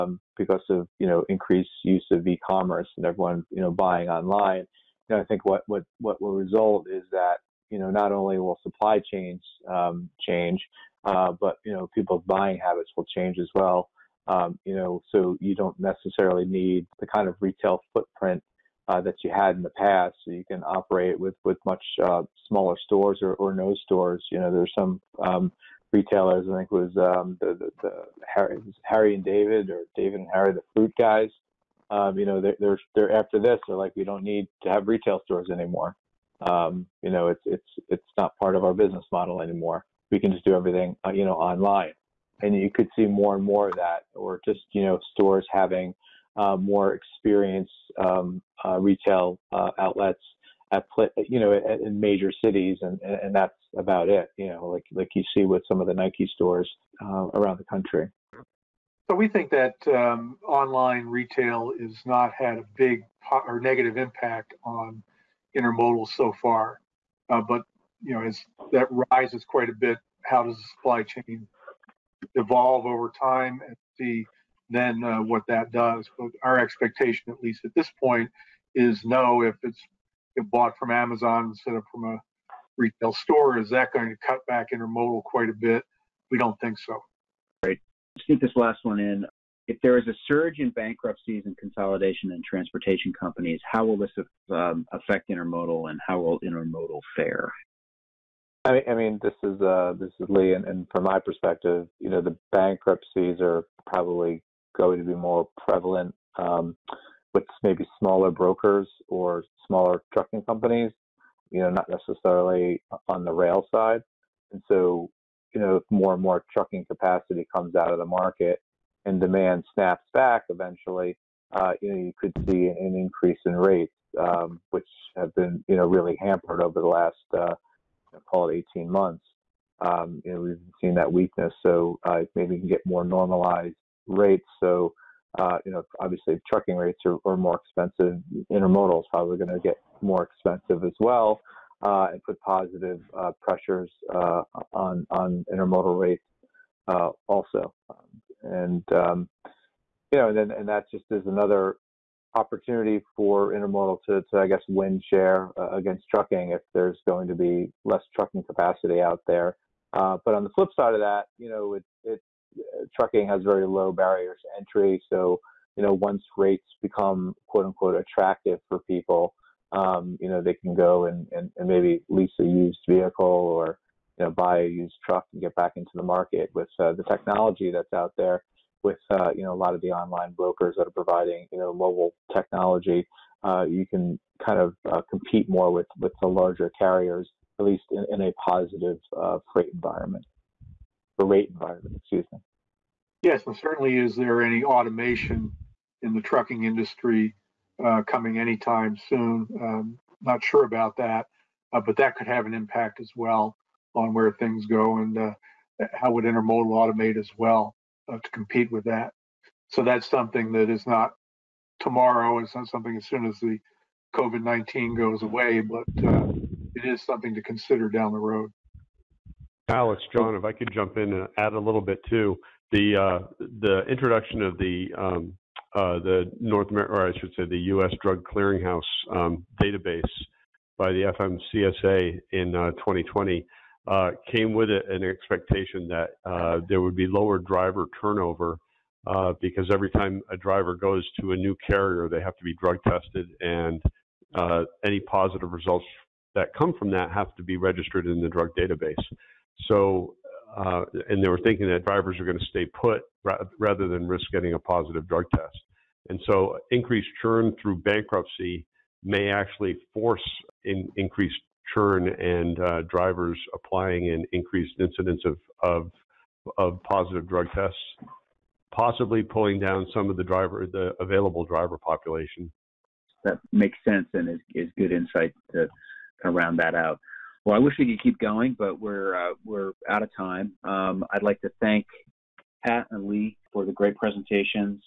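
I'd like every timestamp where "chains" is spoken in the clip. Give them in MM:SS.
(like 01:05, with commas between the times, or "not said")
00:09, 01:11.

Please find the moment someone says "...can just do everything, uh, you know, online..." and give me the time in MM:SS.
00:40.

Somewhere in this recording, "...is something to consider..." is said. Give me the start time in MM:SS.
03:36.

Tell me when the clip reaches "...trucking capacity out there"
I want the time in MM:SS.
02:38.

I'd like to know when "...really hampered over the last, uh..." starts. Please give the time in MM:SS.
02:05.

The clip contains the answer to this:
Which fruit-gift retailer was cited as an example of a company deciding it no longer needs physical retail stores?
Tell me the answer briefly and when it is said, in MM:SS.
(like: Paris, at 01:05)
Harry and David, at 00:28.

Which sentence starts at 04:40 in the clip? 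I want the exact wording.
Um, I'd like to thank Pat and Lee for the great presentations.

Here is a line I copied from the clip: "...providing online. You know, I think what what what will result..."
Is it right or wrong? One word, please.
wrong.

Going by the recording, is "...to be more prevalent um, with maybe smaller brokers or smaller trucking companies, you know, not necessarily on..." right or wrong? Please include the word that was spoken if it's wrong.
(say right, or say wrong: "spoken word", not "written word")
right.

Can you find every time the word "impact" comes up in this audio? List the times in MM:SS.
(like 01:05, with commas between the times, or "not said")
01:03, 03:22.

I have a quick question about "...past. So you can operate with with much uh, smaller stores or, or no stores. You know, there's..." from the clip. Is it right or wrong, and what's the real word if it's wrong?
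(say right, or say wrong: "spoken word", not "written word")
right.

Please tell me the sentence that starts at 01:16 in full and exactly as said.
But our expectation, at least at this point, is no.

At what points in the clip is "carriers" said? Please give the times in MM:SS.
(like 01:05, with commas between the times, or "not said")
03:06, 04:01.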